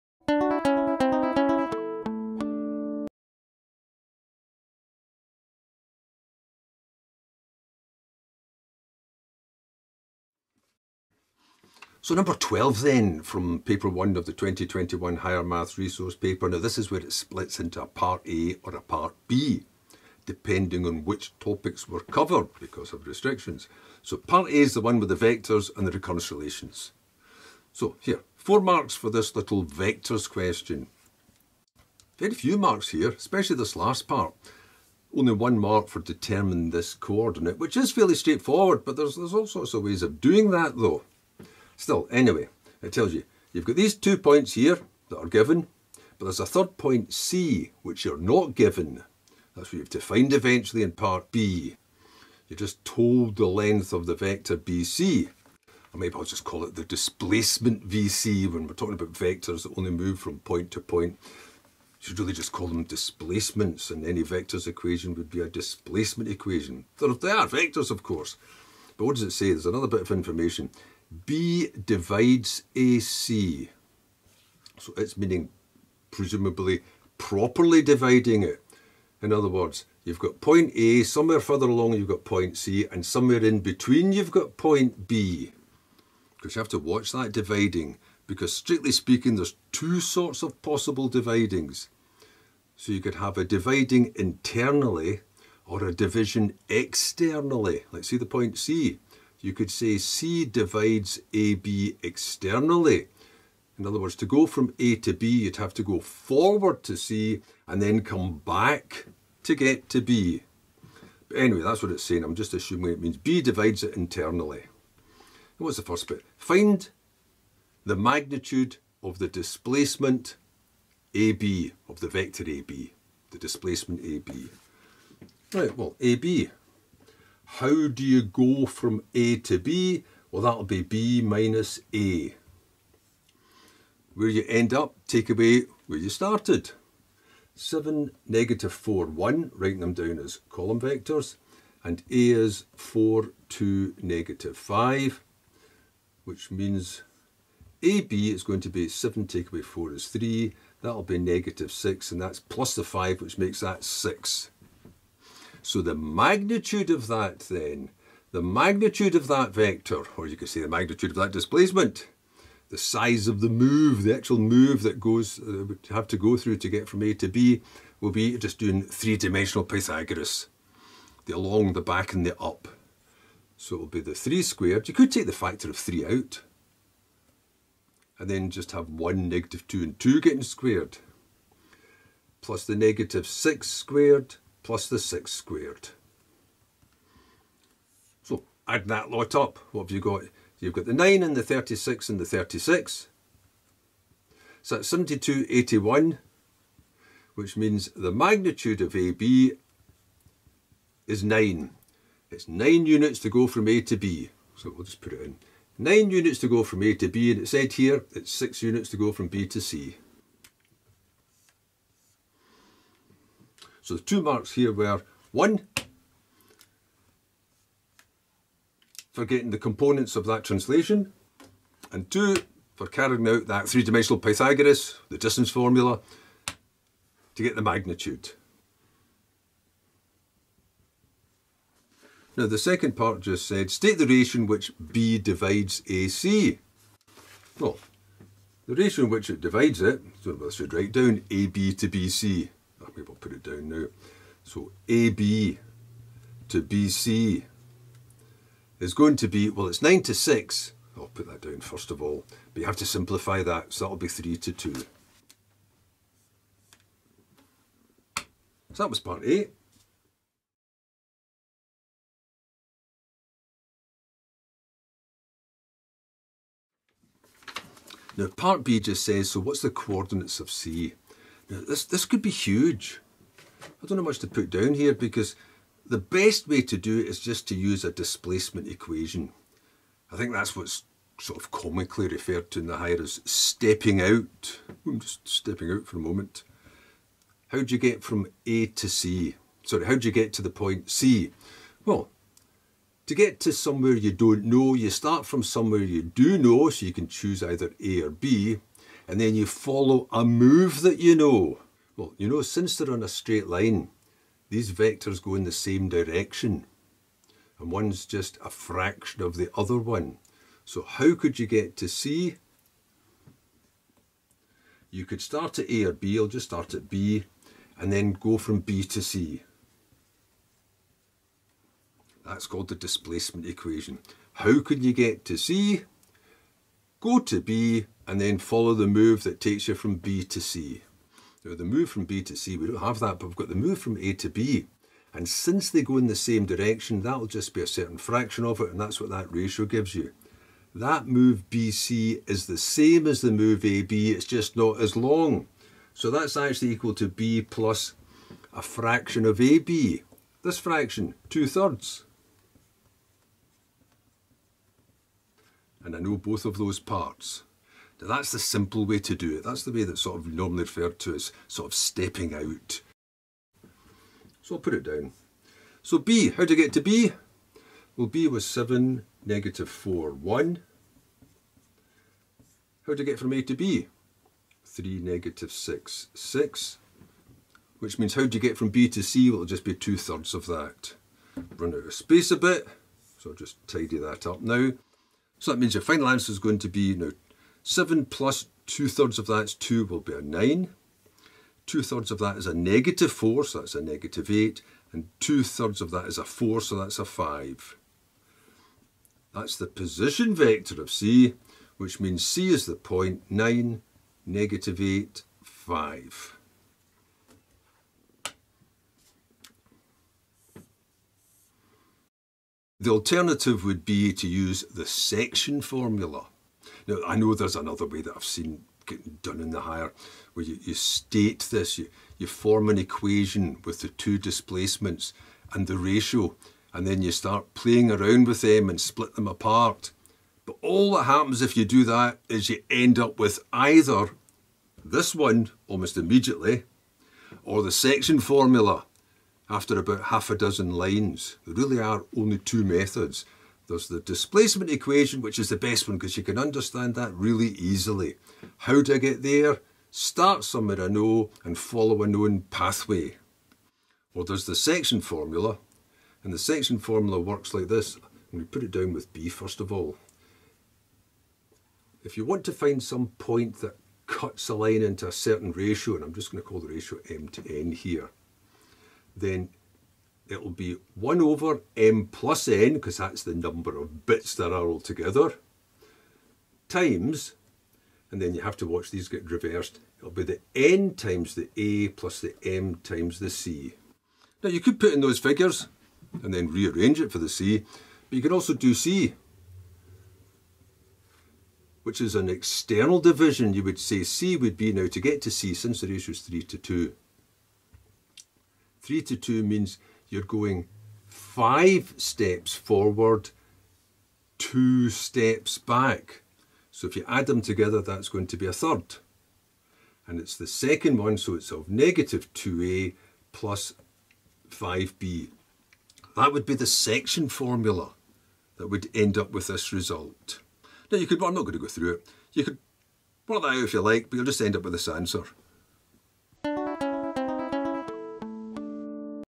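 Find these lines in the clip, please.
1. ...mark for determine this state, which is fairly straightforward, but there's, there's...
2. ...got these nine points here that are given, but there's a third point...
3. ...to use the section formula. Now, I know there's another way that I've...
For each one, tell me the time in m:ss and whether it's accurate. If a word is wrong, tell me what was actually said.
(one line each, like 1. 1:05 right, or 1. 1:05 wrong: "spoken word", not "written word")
1. 0:35 wrong: "coordinate", not "state"
2. 0:43 wrong: "two", not "nine"
3. 6:54 right.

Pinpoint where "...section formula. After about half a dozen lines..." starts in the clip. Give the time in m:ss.
7:17.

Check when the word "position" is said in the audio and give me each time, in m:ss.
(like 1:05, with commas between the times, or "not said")
6:39.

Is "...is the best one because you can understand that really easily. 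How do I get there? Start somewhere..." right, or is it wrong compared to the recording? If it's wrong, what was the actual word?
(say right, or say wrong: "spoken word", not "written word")
right.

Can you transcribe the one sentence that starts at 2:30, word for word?
That'll be negative 6, and that's plus the 5, which makes that 6.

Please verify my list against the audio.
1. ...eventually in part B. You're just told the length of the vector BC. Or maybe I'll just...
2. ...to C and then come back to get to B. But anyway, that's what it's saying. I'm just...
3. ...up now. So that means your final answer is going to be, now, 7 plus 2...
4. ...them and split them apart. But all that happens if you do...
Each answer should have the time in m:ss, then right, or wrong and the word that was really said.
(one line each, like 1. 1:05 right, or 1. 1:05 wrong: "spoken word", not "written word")
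1. 0:50 right
2. 1:46 right
3. 6:24 right
4. 7:08 right.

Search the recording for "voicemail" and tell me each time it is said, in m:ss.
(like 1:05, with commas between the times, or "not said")
not said.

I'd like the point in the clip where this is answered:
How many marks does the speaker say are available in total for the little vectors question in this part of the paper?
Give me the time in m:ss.
0:28.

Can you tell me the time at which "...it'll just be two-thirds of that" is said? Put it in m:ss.
6:19.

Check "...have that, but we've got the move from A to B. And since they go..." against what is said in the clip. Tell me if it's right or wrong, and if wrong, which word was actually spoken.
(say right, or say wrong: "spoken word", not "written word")
right.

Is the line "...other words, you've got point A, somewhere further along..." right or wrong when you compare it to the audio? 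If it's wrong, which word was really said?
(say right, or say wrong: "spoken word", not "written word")
right.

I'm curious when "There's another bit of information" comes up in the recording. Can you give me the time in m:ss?
1:09.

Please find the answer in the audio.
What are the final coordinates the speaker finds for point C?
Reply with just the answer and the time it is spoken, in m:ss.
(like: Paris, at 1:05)
9, -8, 5, at 6:43.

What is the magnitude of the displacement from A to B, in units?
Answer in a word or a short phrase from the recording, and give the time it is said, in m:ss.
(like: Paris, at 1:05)
9, at 3:17.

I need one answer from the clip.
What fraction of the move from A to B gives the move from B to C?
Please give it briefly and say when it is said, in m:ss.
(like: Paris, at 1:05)
two thirds, at 5:51.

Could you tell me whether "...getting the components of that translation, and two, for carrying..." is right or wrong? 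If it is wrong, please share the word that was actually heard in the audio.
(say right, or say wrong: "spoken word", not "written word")
right.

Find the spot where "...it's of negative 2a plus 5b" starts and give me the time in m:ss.
8:31.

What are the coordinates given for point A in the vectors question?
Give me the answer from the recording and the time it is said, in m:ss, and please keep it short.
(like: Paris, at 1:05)
4, 2, -5, at 2:22.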